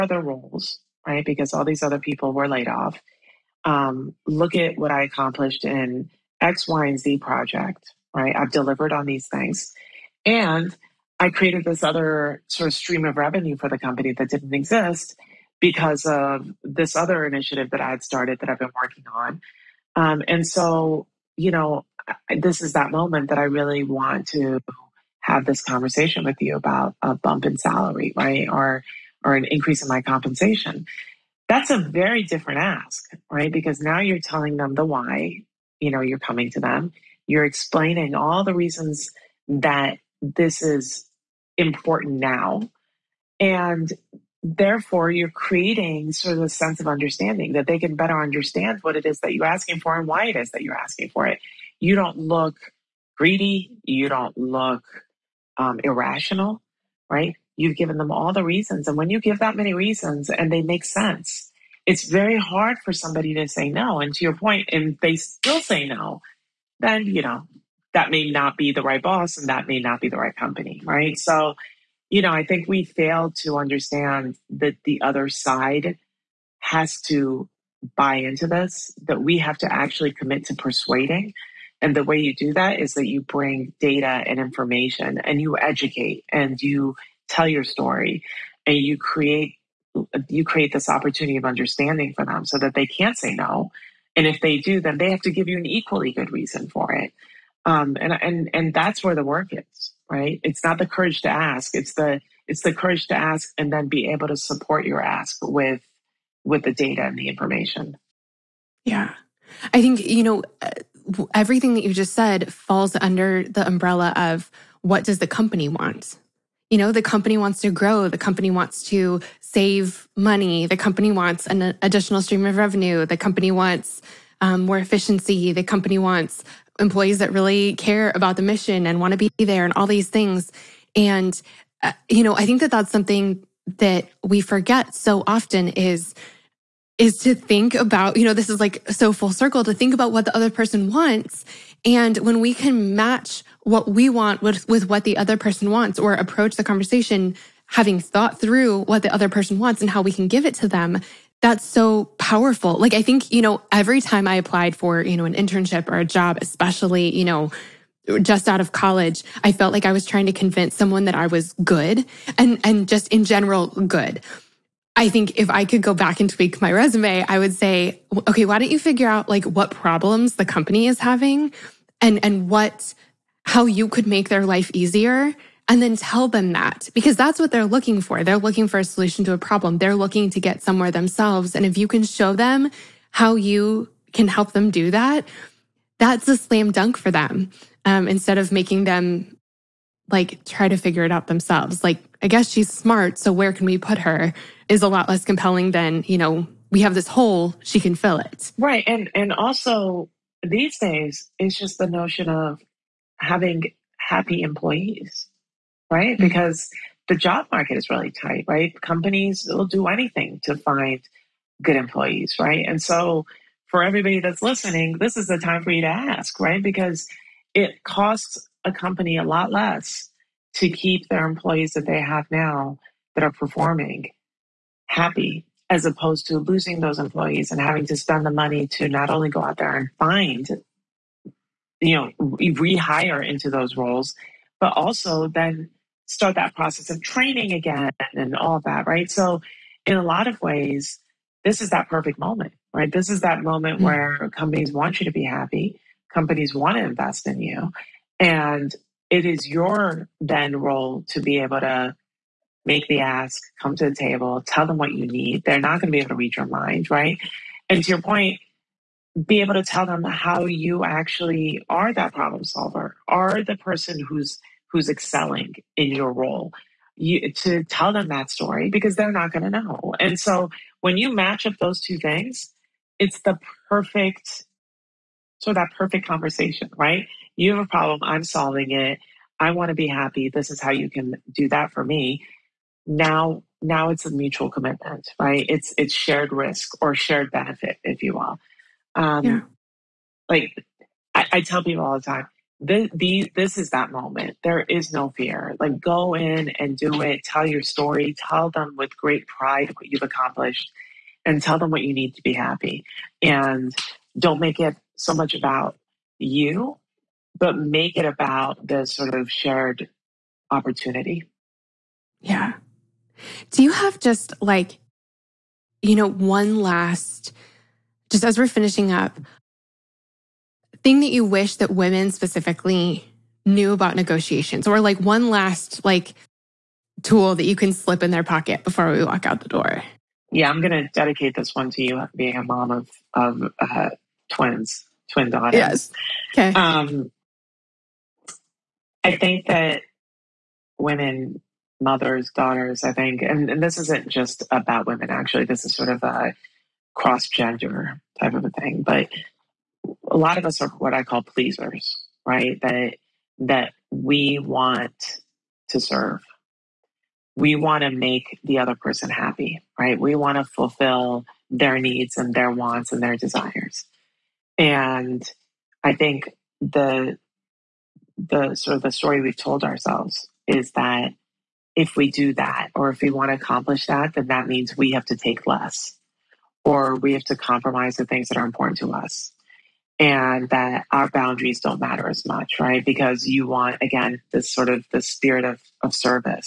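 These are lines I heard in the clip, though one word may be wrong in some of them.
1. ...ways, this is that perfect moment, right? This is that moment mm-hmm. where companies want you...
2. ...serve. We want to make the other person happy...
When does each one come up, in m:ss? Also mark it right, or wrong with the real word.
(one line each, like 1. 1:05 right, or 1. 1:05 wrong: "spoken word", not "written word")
1. 4:00 right
2. 5:55 right.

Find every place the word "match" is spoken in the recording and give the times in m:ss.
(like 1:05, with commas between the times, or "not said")
2:22, 4:31.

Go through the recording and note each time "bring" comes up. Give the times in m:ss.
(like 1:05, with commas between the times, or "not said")
1:23.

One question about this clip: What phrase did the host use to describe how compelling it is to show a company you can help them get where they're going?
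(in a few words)
slam dunk.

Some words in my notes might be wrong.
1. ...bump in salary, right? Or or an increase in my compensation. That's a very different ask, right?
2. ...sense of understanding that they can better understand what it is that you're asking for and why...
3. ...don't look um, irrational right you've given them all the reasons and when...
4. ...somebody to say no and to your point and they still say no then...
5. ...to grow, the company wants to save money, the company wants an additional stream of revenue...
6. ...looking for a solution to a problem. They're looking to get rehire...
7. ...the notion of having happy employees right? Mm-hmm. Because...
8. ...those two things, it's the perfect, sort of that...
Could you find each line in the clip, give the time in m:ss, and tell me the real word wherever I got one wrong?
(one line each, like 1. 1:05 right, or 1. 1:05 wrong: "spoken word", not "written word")
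1. 0:27 right
2. 0:46 right
3. 0:54 right
4. 1:02 right
5. 1:57 right
6. 2:58 wrong: "somewhere", not "rehire"
7. 3:21 right
8. 4:31 right.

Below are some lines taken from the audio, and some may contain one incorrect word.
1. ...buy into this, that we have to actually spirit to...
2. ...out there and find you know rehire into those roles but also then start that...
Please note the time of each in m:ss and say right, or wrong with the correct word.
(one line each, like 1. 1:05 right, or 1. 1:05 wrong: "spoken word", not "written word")
1. 1:17 wrong: "commit", not "spirit"
2. 3:49 right.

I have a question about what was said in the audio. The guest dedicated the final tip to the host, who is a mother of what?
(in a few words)
twin daughters.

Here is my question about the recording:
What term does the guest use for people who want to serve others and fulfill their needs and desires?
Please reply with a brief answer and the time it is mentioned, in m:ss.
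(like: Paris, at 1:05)
pleasers, at 5:51.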